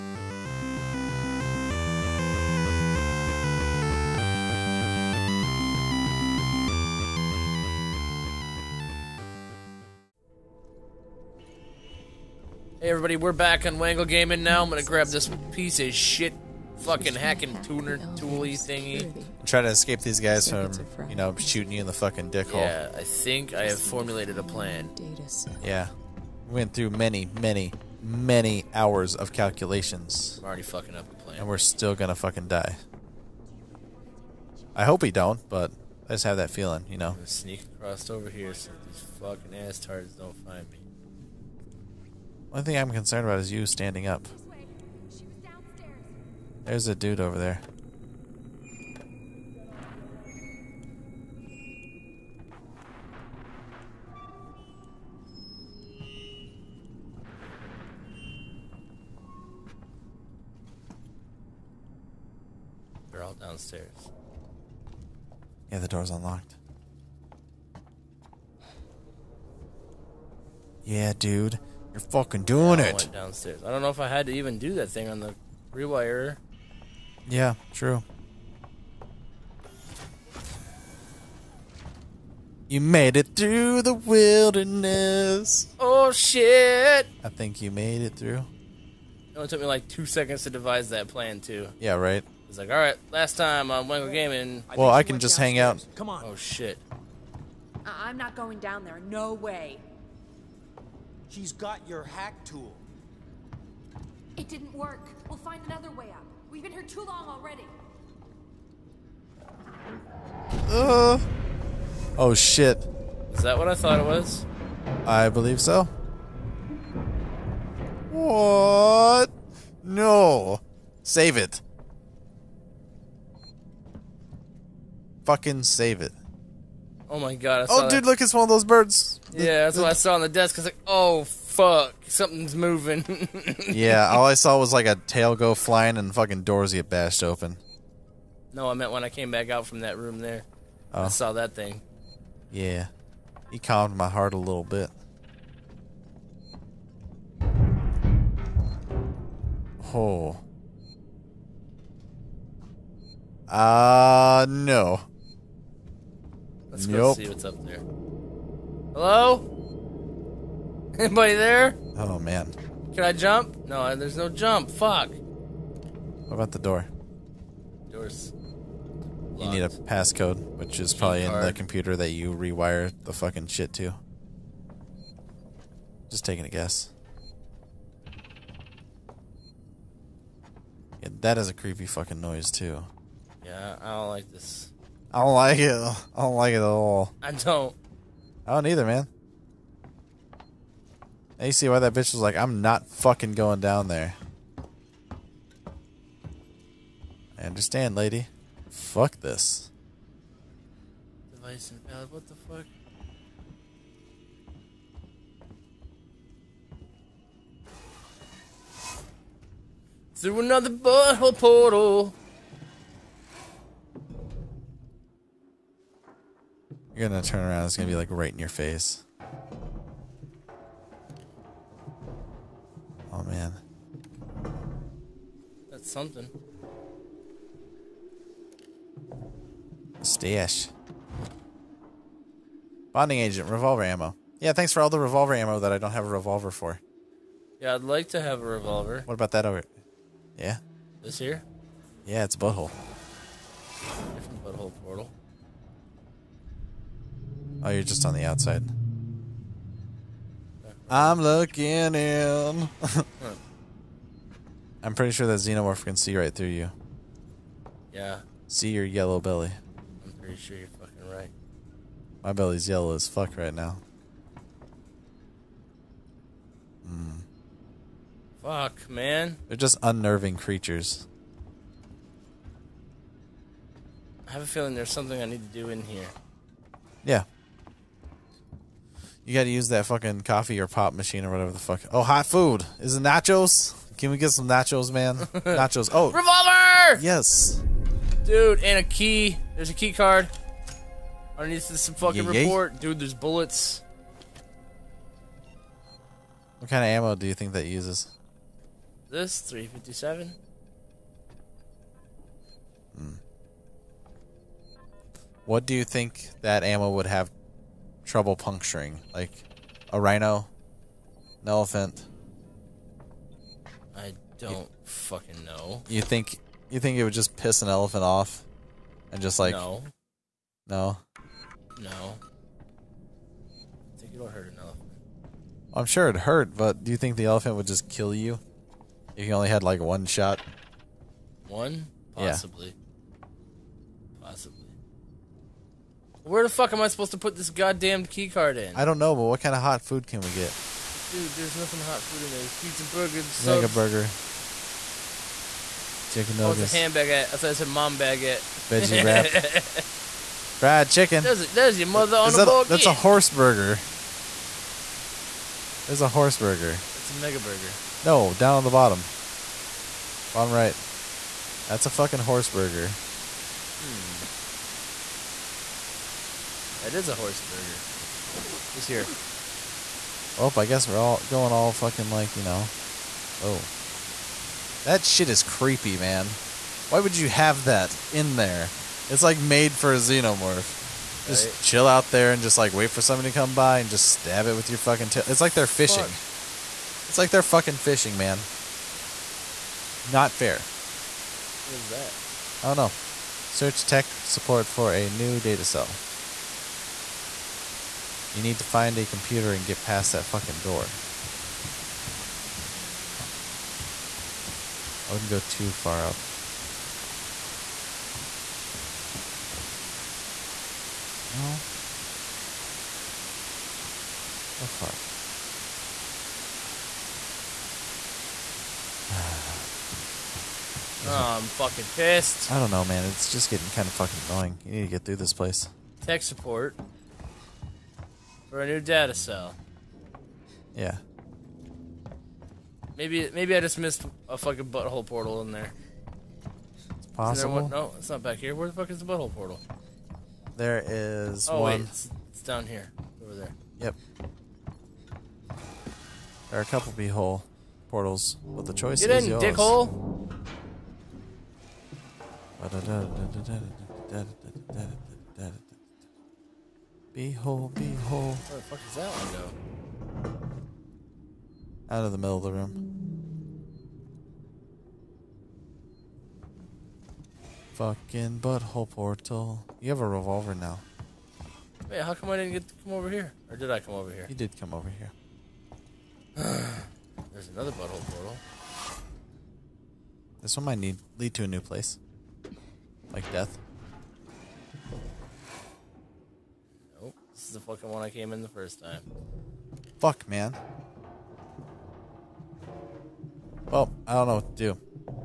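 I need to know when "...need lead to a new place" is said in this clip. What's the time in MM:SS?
08:00.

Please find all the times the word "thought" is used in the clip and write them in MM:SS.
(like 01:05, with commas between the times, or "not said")
01:53, 05:47.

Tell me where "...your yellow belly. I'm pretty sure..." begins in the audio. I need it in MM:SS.
04:18.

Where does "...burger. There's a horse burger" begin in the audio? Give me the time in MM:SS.
05:53.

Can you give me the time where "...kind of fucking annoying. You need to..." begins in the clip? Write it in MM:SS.
07:03.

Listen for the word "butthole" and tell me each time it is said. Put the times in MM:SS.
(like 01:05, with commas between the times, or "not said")
03:30, 04:02, 07:14, 07:19, 07:26, 07:48, 07:57.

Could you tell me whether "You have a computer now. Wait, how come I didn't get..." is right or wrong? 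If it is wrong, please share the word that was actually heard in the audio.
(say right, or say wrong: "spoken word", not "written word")
wrong: "revolver", not "computer".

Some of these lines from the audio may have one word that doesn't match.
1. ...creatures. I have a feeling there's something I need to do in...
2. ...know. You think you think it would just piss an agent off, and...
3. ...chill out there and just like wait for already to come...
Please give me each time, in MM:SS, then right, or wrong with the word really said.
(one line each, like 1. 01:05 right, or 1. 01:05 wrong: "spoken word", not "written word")
1. 04:30 right
2. 05:15 wrong: "elephant", not "agent"
3. 06:21 wrong: "somebody", not "already".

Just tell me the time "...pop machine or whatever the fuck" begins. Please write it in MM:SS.
04:40.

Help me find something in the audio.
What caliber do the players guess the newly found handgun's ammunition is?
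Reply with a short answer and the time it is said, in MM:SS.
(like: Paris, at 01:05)
357, at 04:59.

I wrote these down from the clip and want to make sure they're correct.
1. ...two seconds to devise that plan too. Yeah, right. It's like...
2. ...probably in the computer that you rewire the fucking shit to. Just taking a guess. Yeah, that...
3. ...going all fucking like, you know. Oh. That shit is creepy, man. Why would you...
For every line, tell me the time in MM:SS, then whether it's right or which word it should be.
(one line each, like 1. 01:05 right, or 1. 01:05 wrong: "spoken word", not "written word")
1. 01:29 right
2. 02:50 right
3. 06:11 right.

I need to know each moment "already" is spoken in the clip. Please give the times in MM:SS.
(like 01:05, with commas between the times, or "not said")
00:30, 01:47.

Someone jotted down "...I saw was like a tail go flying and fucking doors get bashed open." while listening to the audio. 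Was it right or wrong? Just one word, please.
right.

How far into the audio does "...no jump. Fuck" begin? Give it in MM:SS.
02:44.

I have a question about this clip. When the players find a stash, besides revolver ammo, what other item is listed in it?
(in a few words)
Bonding agent.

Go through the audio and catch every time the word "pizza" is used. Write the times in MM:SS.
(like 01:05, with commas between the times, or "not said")
05:42.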